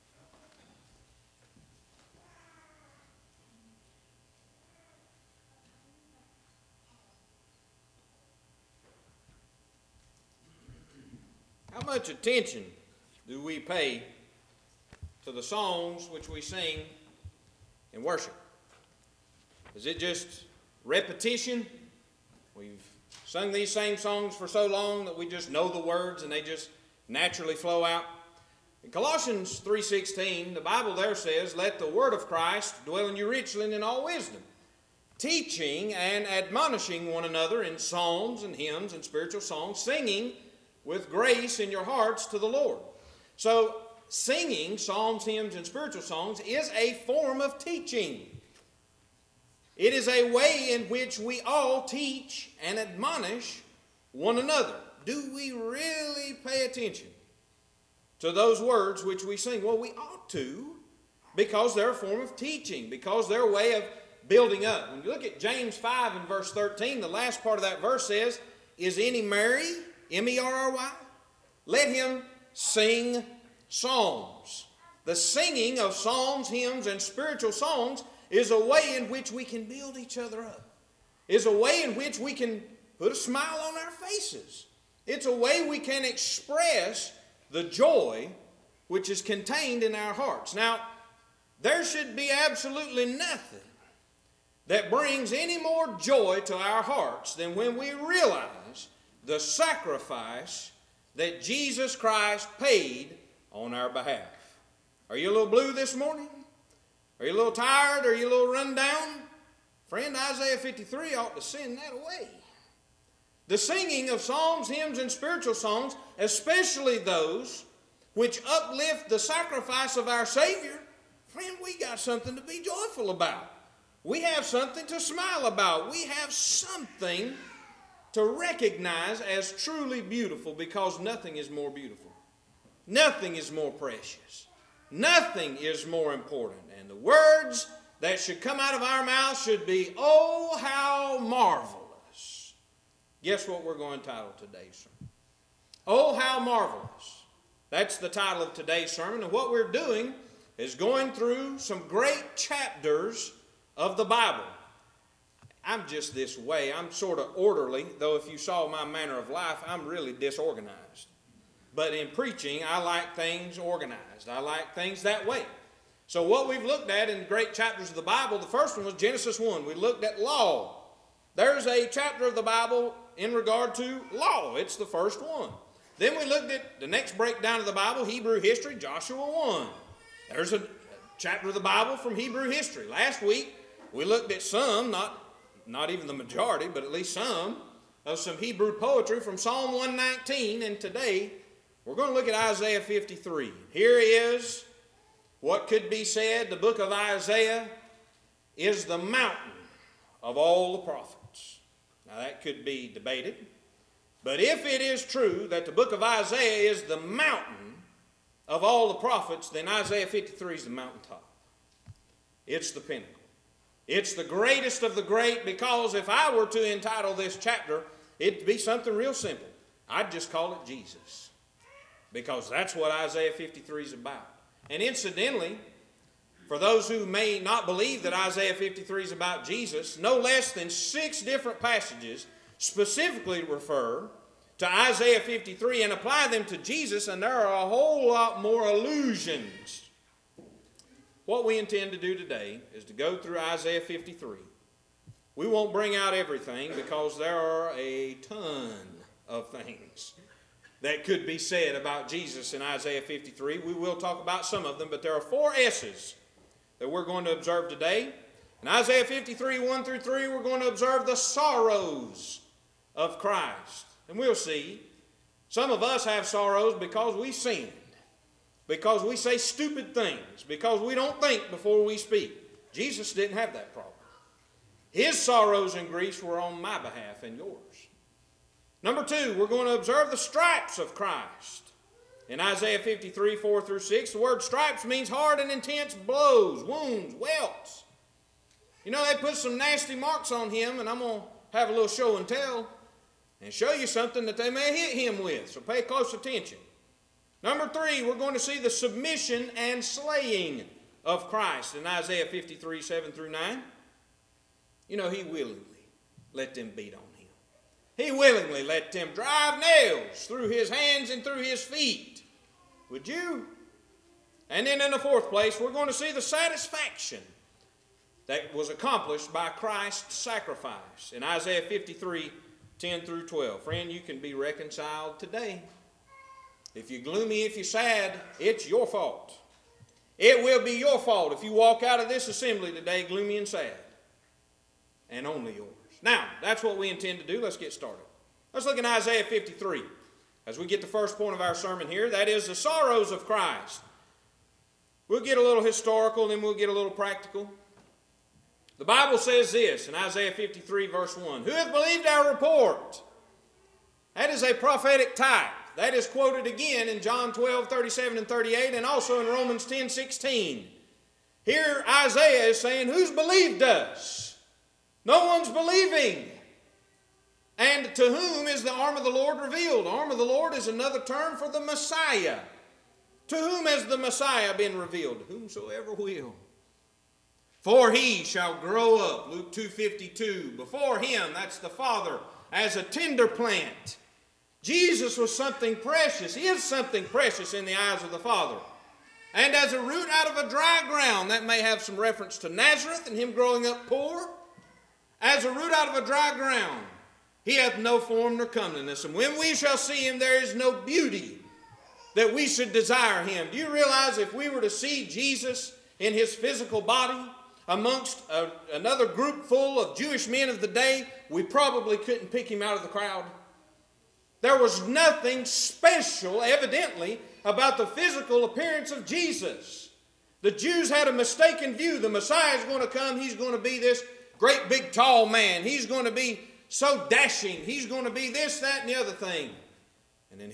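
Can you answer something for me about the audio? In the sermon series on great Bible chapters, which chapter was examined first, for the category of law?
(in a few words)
Genesis 1.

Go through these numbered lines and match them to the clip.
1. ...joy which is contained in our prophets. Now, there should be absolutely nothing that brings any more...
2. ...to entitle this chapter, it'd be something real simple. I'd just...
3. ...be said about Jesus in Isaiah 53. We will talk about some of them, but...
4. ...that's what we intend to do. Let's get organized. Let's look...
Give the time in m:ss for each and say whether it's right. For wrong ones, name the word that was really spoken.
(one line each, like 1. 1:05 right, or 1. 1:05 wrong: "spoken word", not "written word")
1. 1:27 wrong: "hearts", not "prophets"
2. 3:36 right
3. 4:11 right
4. 5:36 wrong: "started", not "organized".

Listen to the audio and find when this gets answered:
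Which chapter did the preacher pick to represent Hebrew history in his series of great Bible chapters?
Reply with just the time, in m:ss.
2:58.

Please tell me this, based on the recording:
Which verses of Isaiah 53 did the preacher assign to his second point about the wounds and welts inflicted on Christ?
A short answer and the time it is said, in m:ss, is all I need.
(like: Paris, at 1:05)
4 through 6, at 4:43.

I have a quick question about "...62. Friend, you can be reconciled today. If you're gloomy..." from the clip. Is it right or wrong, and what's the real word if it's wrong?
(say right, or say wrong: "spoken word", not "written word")
wrong: "12", not "62".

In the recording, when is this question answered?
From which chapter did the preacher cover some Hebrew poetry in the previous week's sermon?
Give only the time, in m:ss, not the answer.
3:09.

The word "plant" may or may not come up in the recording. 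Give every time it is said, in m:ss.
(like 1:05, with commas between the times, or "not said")
6:23.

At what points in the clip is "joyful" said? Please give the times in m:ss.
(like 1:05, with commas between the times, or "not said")
2:02.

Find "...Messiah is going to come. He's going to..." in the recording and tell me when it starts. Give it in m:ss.
7:02.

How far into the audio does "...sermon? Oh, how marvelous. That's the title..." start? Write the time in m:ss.
2:24.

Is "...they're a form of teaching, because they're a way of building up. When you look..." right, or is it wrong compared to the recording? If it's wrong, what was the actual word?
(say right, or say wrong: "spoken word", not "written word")
right.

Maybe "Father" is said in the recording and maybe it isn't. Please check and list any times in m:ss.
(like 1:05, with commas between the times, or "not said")
6:21, 6:28.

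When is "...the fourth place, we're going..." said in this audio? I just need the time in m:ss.
5:14.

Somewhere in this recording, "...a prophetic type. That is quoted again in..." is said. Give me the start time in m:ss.
5:54.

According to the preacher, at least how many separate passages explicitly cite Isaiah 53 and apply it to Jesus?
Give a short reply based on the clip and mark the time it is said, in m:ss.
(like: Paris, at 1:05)
6, at 3:50.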